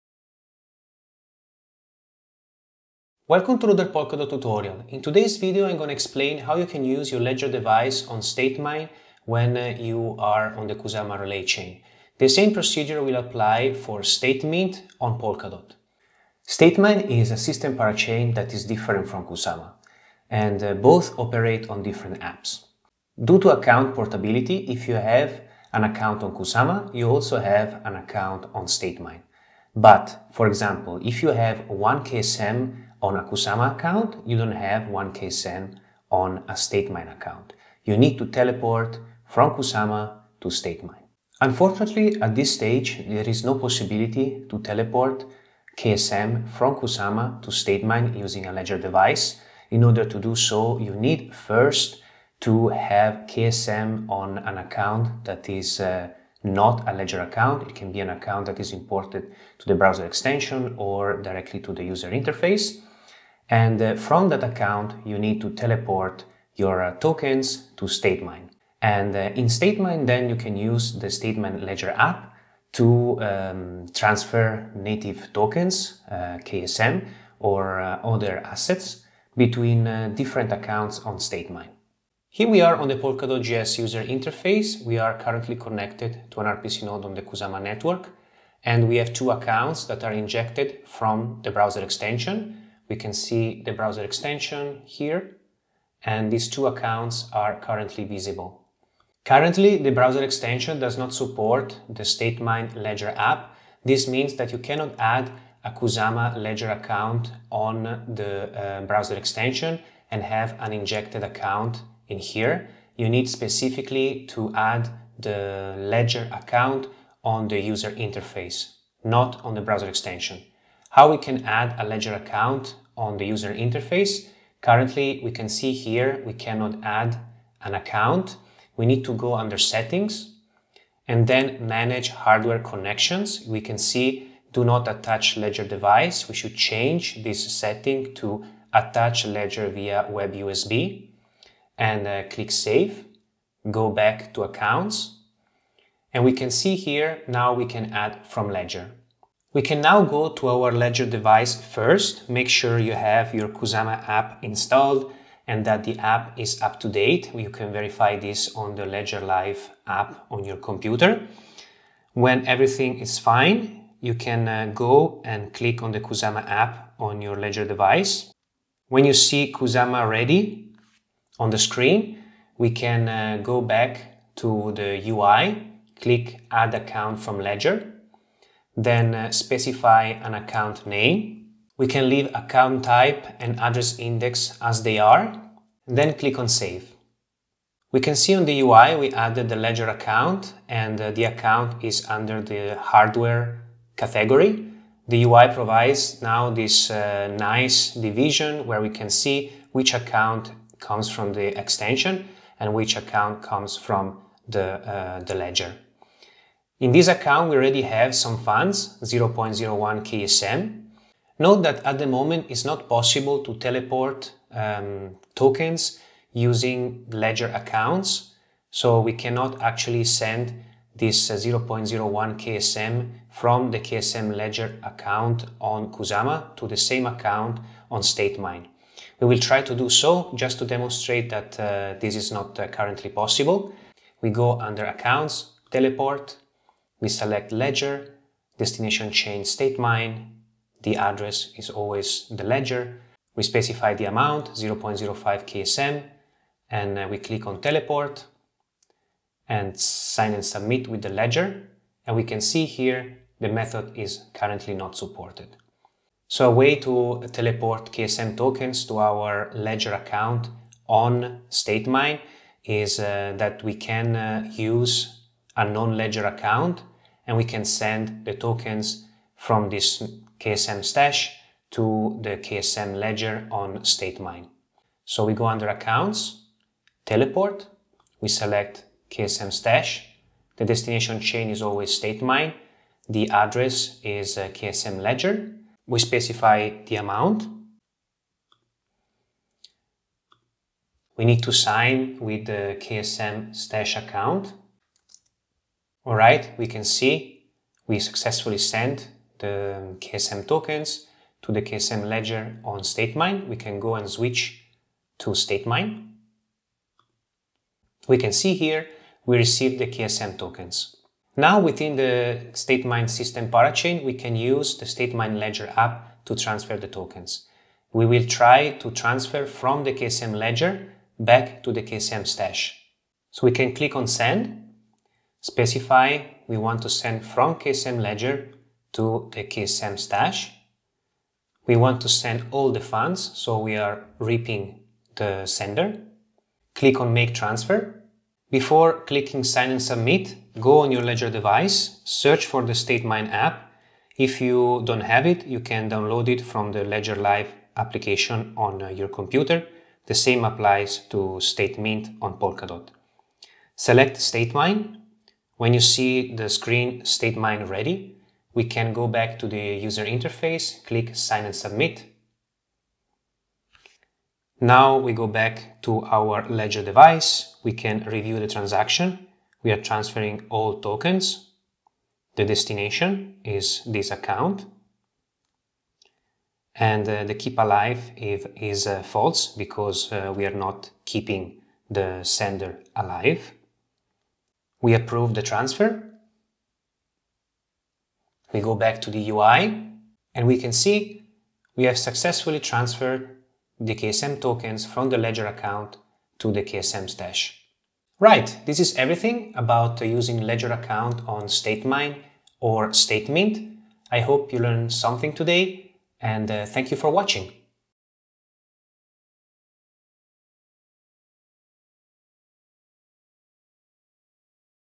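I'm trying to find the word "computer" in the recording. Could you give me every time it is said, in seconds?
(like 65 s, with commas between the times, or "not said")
160 s, 349 s.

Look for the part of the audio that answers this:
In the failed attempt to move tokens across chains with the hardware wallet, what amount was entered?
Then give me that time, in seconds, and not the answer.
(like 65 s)
244 s.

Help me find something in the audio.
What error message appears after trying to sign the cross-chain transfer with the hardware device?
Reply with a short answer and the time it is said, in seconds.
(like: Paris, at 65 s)
method is currently not supported, at 253 s.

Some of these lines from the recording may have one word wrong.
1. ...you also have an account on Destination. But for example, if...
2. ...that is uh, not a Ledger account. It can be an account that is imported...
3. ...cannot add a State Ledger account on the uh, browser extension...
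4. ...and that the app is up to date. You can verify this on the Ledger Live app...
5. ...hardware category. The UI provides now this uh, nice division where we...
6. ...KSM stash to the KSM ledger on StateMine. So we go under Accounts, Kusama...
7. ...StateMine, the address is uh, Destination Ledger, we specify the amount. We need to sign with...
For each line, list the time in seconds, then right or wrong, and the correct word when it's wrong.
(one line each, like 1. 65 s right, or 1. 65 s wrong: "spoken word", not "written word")
1. 26 s wrong: "StateMine", not "Destination"
2. 55 s right
3. 104 s wrong: "Kusama", not "State"
4. 155 s right
5. 192 s right
6. 270 s wrong: "Teleport", not "Kusama"
7. 282 s wrong: "KSM", not "Destination".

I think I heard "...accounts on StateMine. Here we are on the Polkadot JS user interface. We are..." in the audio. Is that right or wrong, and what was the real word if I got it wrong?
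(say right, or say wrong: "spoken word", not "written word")
right.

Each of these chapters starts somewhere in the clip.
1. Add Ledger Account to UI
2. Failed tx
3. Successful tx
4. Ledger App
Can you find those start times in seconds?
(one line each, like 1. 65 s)
1. 99 s
2. 211 s
3. 256 s
4. 311 s.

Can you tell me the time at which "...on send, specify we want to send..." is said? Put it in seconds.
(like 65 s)
323 s.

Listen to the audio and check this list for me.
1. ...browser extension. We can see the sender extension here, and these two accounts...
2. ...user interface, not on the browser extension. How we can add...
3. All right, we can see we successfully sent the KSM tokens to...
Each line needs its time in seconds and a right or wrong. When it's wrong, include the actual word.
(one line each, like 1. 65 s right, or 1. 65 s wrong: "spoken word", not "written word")
1. 91 s wrong: "browser", not "sender"
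2. 117 s right
3. 296 s right.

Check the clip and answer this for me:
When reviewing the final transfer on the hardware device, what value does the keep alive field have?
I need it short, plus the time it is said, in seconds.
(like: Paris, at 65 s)
false, at 379 s.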